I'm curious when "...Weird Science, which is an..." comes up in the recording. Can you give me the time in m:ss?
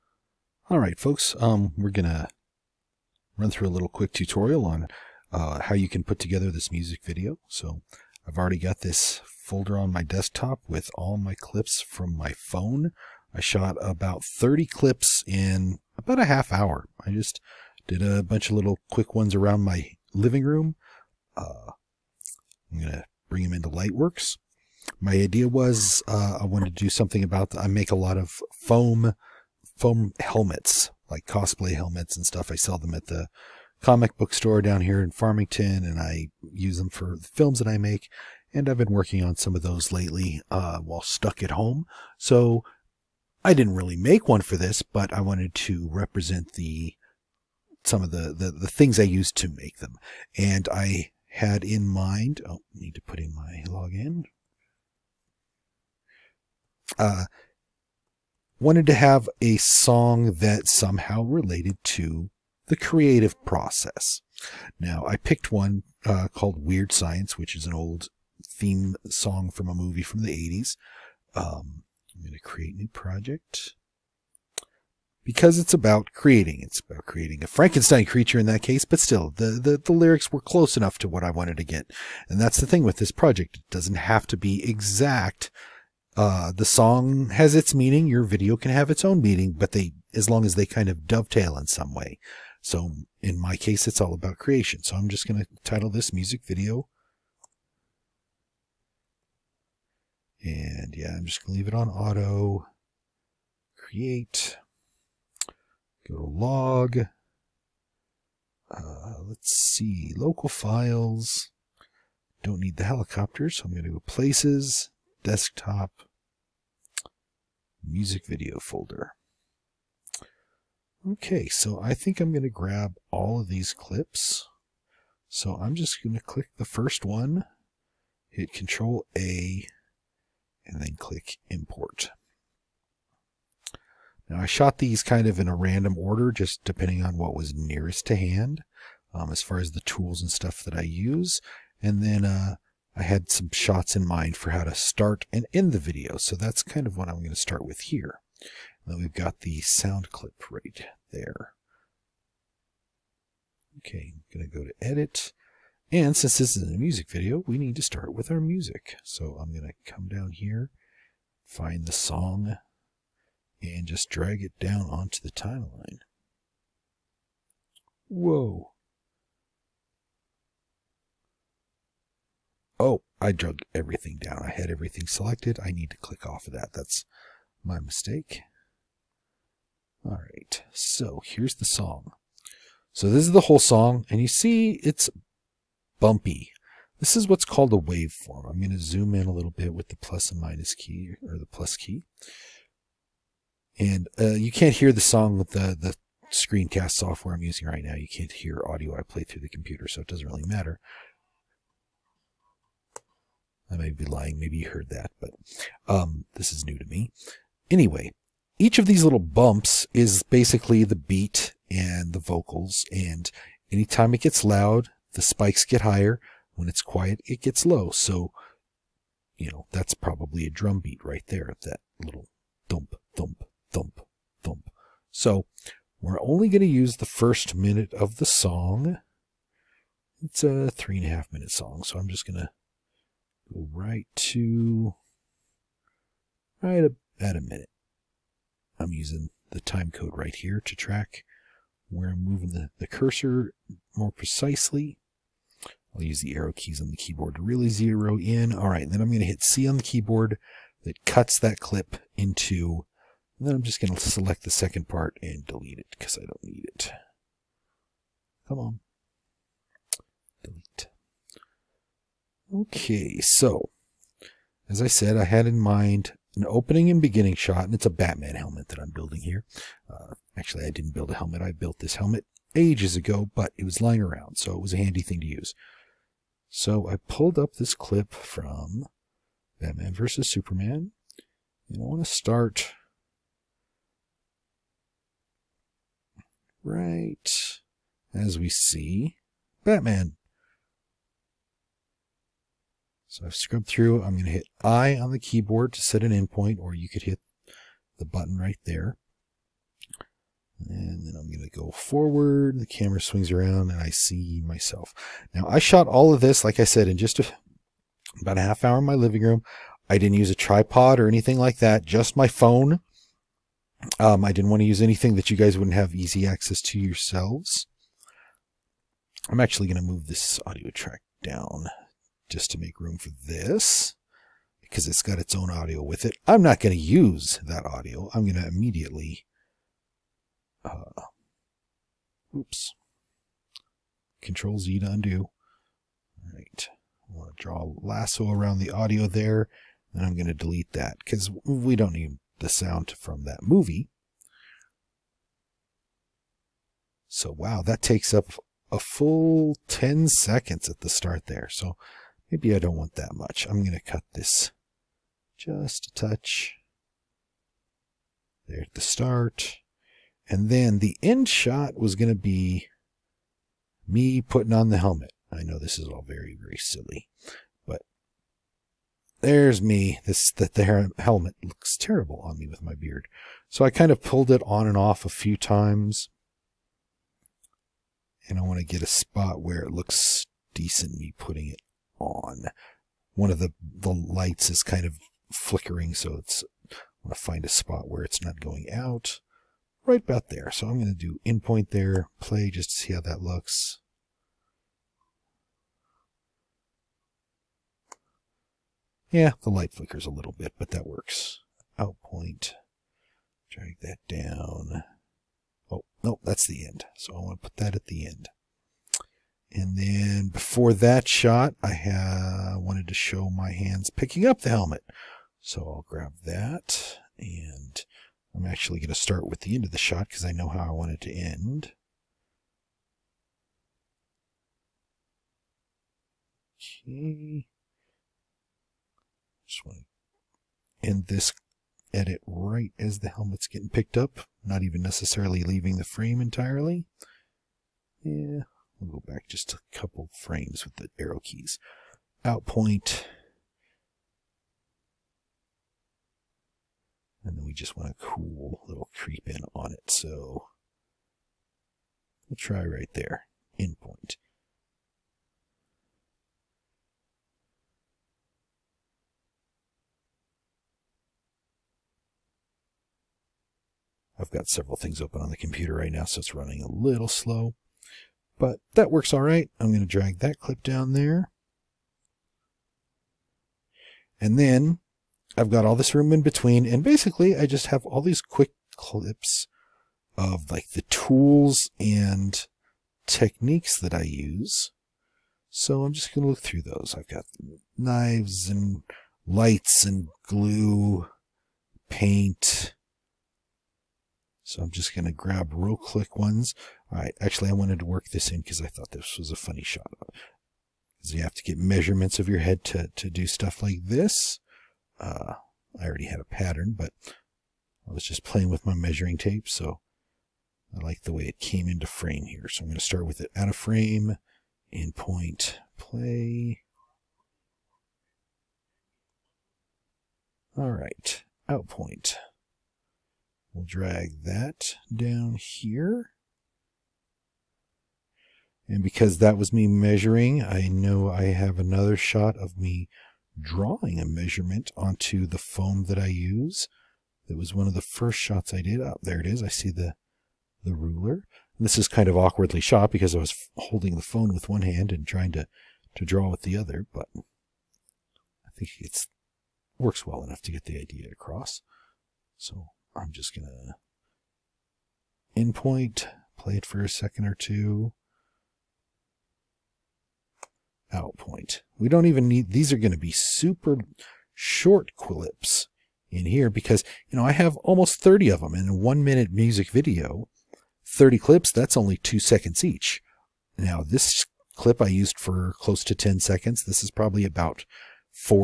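1:06.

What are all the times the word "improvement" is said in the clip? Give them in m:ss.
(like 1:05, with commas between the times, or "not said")
not said.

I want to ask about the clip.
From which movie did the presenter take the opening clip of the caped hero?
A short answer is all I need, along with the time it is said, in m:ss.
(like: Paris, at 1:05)
Batman vs. Superman, at 4:39.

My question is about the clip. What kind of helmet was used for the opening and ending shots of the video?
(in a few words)
Batman helmet.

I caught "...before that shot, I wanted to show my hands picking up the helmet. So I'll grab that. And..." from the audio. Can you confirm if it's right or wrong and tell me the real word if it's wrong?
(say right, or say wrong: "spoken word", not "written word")
right.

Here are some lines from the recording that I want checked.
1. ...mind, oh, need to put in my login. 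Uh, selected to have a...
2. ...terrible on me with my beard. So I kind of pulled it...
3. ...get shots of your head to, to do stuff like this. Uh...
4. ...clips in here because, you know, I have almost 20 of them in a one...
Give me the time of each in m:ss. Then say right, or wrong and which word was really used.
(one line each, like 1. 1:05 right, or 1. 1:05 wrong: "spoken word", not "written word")
1. 0:51 wrong: "wanted", not "selected"
2. 6:11 right
3. 8:21 wrong: "measurements", not "shots"
4. 9:24 wrong: "30", not "20".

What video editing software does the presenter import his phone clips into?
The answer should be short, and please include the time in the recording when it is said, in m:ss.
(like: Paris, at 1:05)
Lightworks, at 0:23.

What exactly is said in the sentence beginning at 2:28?
And then we've got the sound clip right there.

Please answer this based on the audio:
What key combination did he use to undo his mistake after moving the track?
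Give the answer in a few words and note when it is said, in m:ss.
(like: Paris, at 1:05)
Control Z, at 5:34.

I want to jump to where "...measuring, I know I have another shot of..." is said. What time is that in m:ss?
8:49.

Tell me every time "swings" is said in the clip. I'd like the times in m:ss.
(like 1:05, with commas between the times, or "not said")
5:02.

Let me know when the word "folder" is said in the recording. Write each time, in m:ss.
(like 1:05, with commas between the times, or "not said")
0:09, 1:58.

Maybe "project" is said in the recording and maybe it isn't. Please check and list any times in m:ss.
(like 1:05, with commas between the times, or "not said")
1:12, 1:23.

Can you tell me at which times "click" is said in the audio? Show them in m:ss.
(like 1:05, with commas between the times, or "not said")
2:06, 2:10, 2:55.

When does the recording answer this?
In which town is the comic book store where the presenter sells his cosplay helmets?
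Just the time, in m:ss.
0:35.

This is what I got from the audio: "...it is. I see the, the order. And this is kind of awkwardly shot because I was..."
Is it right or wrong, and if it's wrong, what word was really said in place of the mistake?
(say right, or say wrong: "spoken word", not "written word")
wrong: "ruler", not "order".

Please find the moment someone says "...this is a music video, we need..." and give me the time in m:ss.
2:36.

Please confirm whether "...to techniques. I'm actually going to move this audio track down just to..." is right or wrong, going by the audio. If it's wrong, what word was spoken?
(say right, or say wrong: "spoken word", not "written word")
wrong: "yourselves", not "techniques".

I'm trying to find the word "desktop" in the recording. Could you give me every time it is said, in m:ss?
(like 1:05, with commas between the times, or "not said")
0:10, 1:55.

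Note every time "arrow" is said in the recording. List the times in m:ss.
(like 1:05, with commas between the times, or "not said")
4:06, 7:20.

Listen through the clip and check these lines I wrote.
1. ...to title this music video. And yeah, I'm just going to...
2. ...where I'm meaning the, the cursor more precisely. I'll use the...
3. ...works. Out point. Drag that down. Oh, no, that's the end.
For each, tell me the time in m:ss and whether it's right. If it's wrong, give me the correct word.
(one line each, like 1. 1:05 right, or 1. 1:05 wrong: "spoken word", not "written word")
1. 1:35 right
2. 4:01 wrong: "moving", not "meaning"
3. 6:40 right.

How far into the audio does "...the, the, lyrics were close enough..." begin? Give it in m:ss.
1:19.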